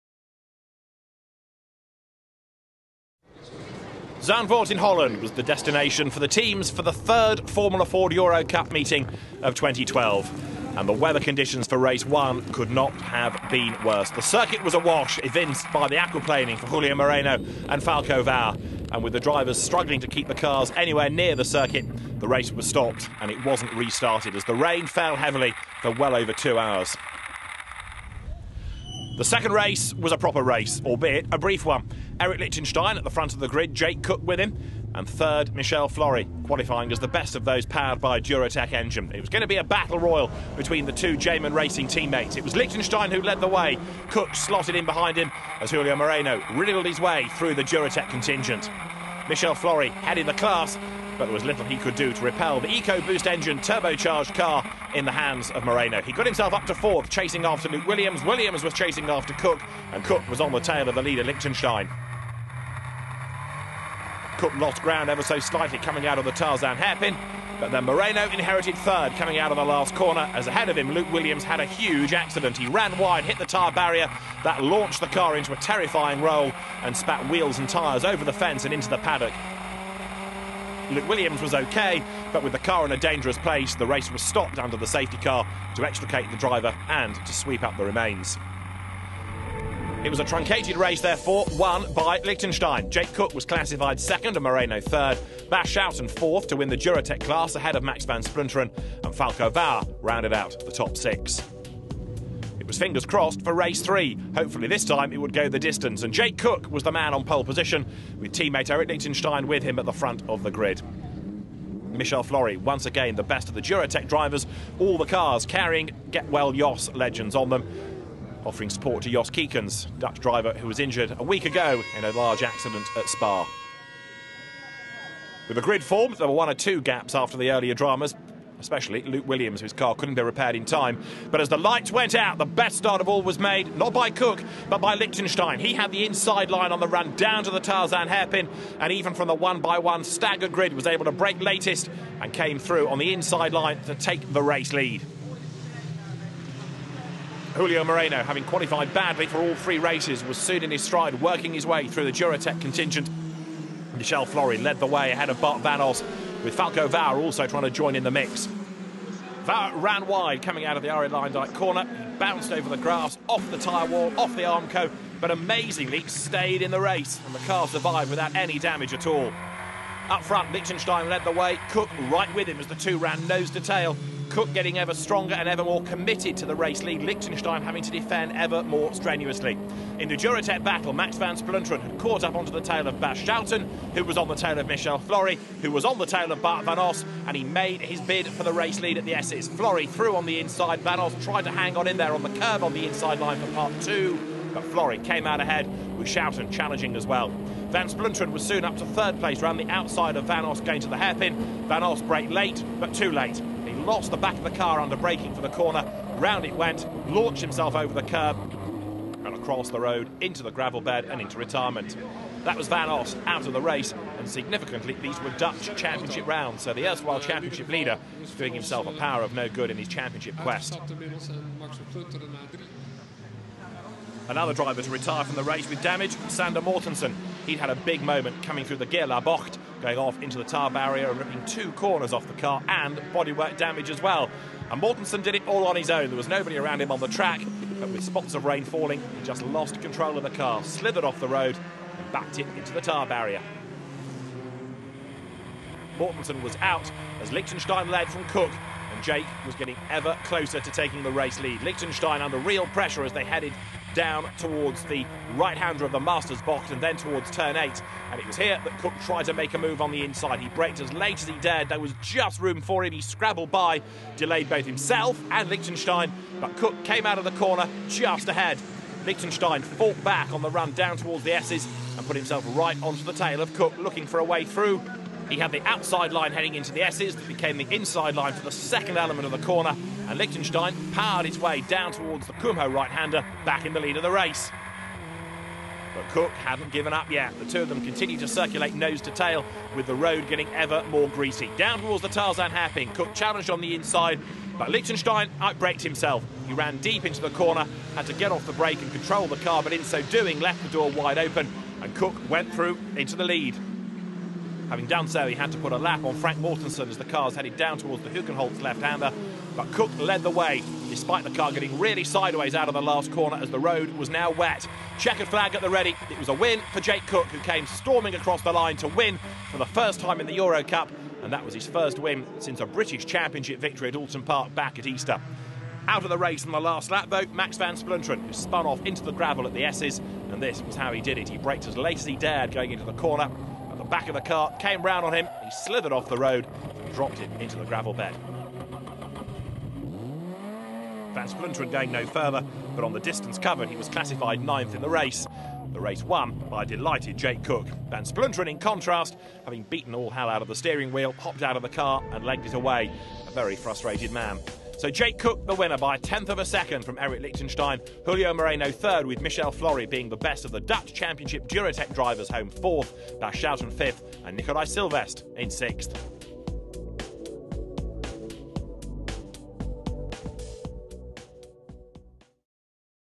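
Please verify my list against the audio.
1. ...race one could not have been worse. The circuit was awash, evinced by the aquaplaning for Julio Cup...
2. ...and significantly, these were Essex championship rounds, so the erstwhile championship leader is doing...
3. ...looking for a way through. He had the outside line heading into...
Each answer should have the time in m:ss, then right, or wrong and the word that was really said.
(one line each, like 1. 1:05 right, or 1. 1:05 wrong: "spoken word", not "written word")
1. 0:11 wrong: "Moreno", not "Cup"
2. 3:34 wrong: "Dutch", not "Essex"
3. 4:33 right.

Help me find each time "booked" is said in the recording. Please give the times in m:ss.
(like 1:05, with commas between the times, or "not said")
not said.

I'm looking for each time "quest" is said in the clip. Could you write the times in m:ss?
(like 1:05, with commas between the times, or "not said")
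3:40.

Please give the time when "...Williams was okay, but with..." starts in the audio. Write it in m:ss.
1:21.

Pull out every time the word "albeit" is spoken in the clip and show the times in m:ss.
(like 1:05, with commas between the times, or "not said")
0:30.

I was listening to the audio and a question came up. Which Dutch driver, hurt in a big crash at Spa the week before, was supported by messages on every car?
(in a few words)
Jos Keekens.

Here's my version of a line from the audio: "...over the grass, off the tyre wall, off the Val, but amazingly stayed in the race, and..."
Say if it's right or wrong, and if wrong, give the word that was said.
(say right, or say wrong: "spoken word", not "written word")
wrong: "Armco", not "Val".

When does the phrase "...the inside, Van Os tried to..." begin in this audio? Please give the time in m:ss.
3:10.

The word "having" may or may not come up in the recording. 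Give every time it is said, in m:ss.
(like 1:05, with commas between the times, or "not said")
2:28, 2:57, 5:04, 5:49.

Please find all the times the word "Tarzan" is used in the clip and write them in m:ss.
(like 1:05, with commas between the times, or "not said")
1:06, 2:17, 4:52.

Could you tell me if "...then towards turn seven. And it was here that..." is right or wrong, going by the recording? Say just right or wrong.
wrong.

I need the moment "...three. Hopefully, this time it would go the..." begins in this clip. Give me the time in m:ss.
1:43.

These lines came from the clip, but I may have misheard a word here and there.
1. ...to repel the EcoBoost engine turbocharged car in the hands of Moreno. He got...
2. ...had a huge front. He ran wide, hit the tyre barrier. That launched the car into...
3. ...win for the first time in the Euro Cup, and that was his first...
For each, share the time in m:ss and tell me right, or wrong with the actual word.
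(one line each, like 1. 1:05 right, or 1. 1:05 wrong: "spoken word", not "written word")
1. 0:52 right
2. 1:11 wrong: "accident", not "front"
3. 5:18 right.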